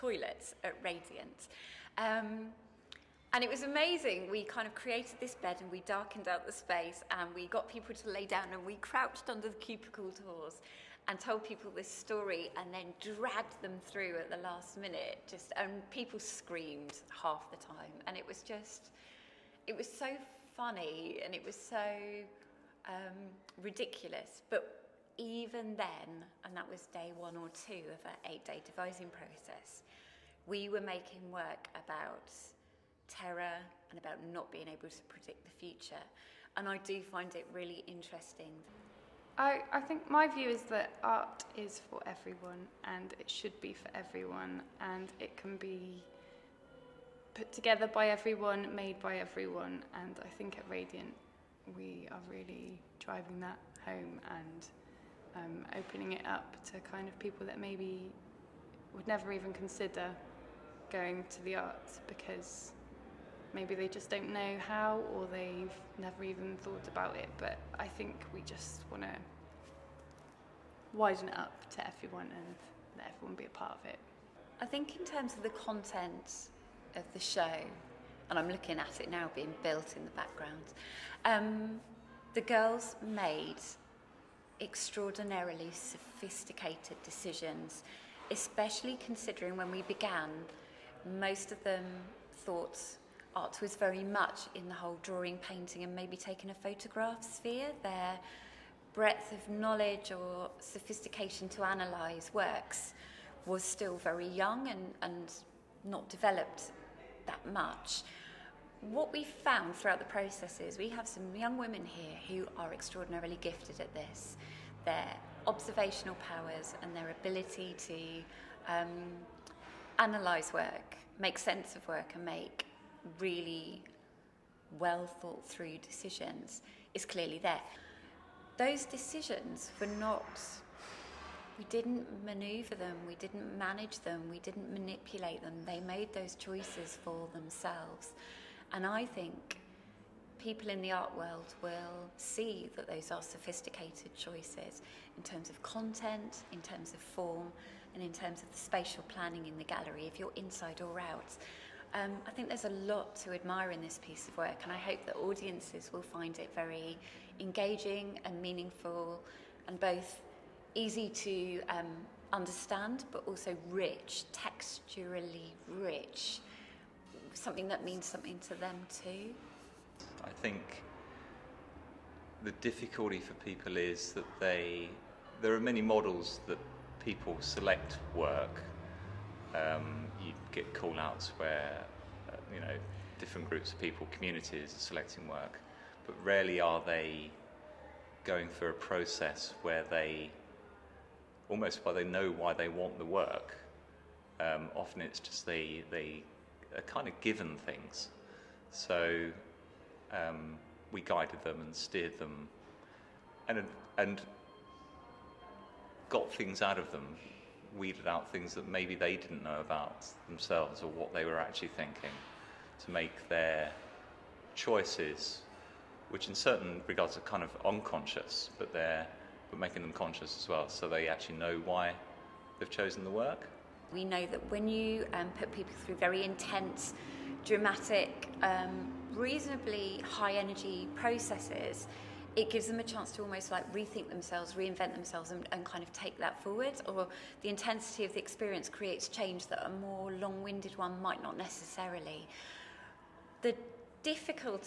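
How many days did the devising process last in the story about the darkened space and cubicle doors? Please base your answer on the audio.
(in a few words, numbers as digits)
8.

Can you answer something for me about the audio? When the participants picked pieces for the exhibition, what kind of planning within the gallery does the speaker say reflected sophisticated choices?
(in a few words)
Spatial planning.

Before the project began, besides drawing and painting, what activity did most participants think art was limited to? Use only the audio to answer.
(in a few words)
Taking a photograph.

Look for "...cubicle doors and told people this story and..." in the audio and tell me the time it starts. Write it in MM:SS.
00:09.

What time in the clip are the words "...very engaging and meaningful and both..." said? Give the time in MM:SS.
02:36.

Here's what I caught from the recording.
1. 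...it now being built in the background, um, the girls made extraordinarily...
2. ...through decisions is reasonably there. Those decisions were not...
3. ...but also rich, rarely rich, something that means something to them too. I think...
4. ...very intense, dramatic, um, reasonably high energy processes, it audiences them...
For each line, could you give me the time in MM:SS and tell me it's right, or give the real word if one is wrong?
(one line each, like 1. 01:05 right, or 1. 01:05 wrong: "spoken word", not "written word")
1. 01:19 right
2. 02:05 wrong: "clearly", not "reasonably"
3. 02:43 wrong: "texturally", not "rarely"
4. 03:45 wrong: "gives", not "audiences".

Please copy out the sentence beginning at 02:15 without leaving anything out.
They made those choices for themselves.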